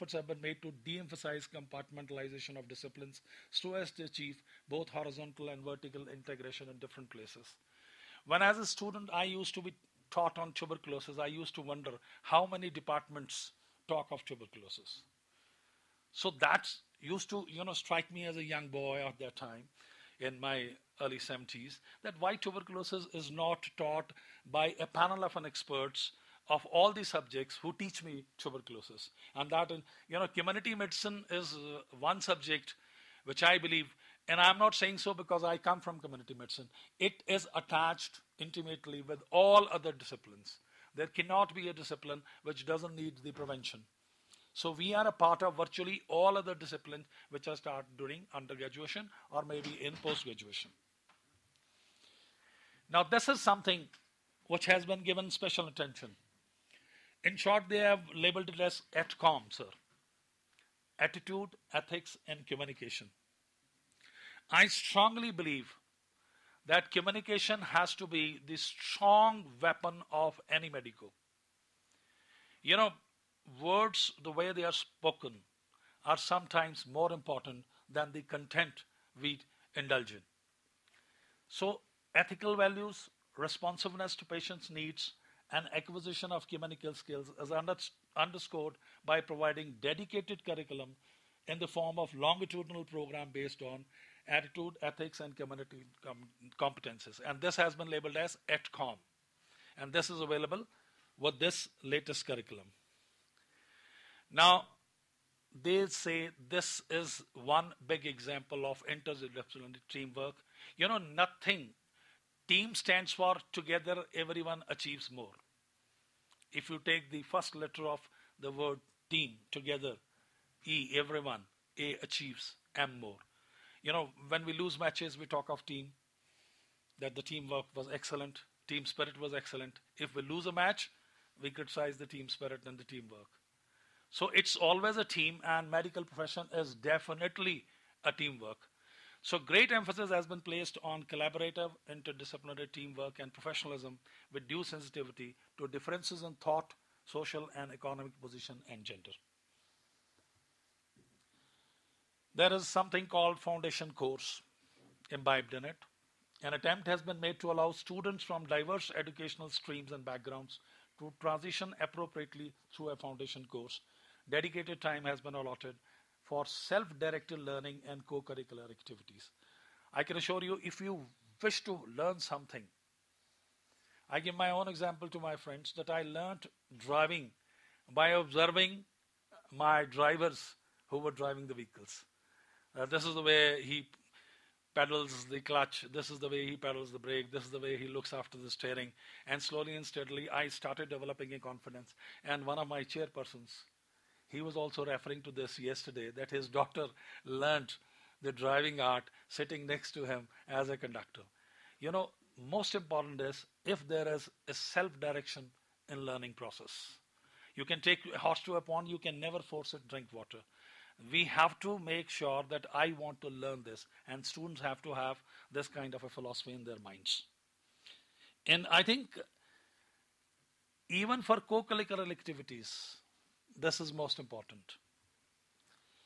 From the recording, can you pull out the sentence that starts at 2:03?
You know, when we lose matches, we talk of team, that the teamwork was excellent, team spirit was excellent.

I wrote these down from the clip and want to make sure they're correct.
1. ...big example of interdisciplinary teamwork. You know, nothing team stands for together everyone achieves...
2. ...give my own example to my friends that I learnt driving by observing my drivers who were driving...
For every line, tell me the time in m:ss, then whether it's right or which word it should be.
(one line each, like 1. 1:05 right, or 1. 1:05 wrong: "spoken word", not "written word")
1. 1:47 right
2. 2:54 right.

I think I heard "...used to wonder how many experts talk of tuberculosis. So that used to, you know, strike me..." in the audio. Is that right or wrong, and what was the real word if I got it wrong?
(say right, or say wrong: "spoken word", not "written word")
wrong: "departments", not "experts".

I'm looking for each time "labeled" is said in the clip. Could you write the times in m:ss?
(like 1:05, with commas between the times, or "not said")
0:58, 1:37.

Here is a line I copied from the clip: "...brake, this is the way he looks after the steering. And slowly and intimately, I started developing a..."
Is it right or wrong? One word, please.
wrong.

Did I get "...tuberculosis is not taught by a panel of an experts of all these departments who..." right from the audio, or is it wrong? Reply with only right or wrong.
wrong.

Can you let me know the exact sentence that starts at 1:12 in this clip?
You know, words, the way they are spoken, are sometimes more important than the content we indulge in.